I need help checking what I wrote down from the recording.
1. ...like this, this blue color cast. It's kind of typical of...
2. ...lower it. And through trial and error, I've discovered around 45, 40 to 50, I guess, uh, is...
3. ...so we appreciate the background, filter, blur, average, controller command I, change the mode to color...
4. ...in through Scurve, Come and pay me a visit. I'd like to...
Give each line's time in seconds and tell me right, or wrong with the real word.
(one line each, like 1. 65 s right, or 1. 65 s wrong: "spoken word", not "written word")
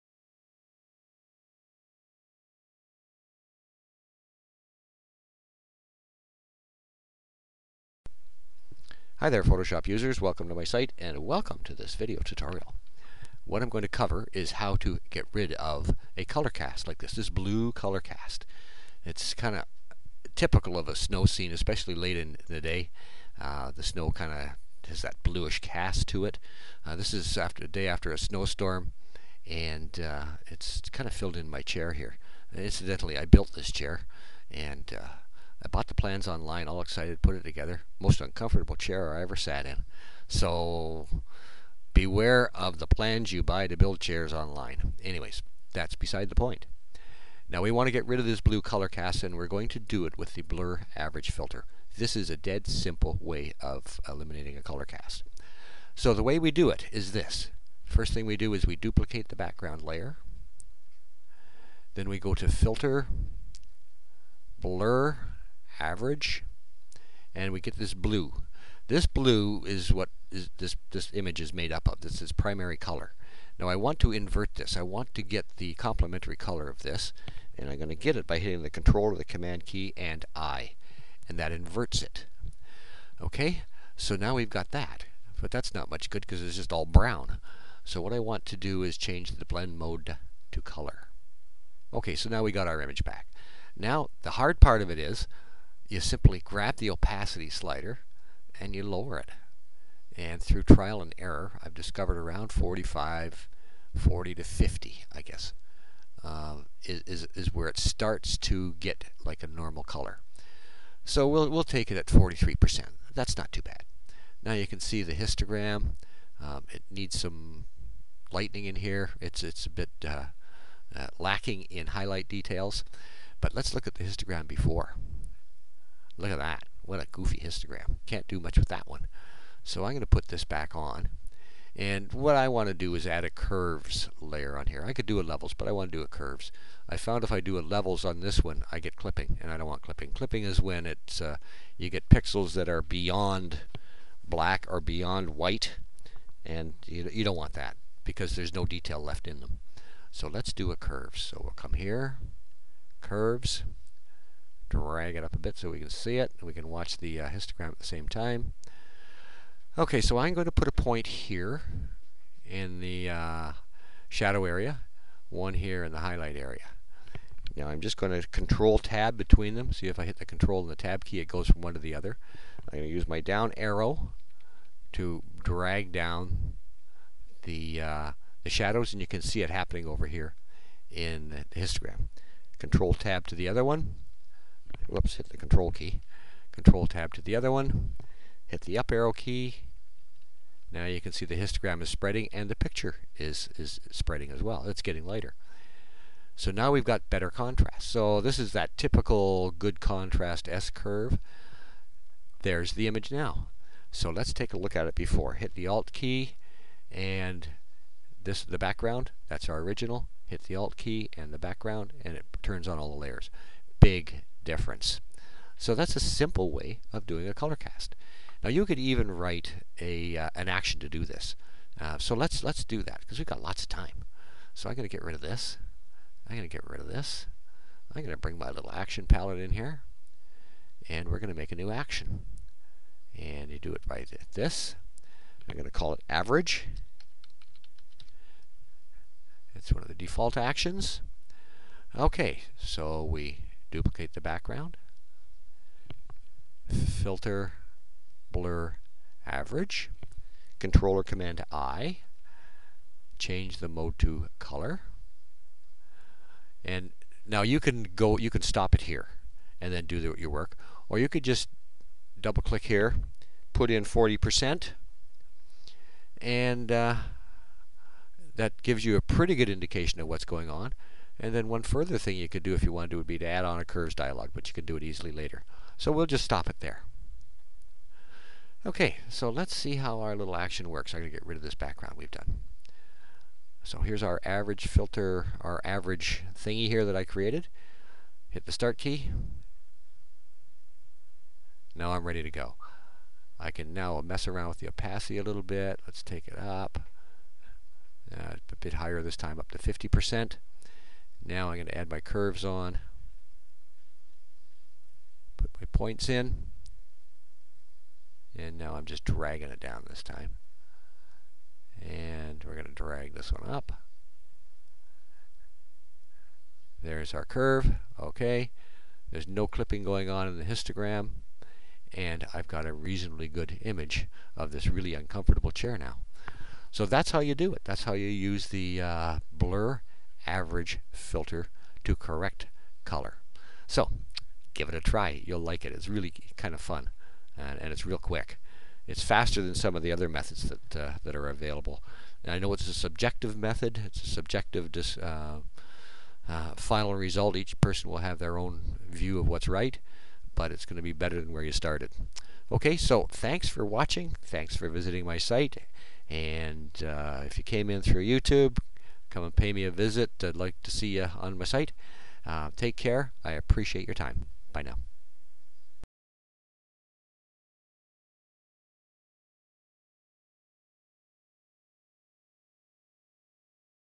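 1. 16 s right
2. 98 s right
3. 242 s wrong: "duplicate", not "appreciate"
4. 357 s wrong: "YouTube", not "Scurve".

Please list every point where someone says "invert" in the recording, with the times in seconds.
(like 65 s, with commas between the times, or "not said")
74 s, 81 s.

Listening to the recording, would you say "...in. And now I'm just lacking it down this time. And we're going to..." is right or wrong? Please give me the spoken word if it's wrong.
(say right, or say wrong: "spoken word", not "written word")
wrong: "dragging", not "lacking".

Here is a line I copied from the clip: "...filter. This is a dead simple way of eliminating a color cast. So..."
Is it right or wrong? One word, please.
right.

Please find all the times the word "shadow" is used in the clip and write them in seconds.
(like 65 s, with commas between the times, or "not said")
164 s, 178 s.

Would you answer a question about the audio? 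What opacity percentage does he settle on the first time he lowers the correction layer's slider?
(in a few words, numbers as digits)
43%.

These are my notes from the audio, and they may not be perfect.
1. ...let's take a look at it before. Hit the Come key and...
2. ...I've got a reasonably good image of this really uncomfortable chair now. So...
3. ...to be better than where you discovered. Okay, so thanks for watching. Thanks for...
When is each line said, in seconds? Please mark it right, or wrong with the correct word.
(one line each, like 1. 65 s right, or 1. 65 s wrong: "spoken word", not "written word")
1. 204 s wrong: "Alt", not "Come"
2. 322 s right
3. 350 s wrong: "started", not "discovered".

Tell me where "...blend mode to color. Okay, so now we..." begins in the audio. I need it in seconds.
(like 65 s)
89 s.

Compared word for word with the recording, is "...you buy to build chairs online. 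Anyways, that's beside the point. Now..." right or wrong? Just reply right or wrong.
right.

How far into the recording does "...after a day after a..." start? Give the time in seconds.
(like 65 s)
27 s.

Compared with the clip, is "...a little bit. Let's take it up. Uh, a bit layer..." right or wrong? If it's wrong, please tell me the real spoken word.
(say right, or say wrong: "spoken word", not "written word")
wrong: "higher", not "layer".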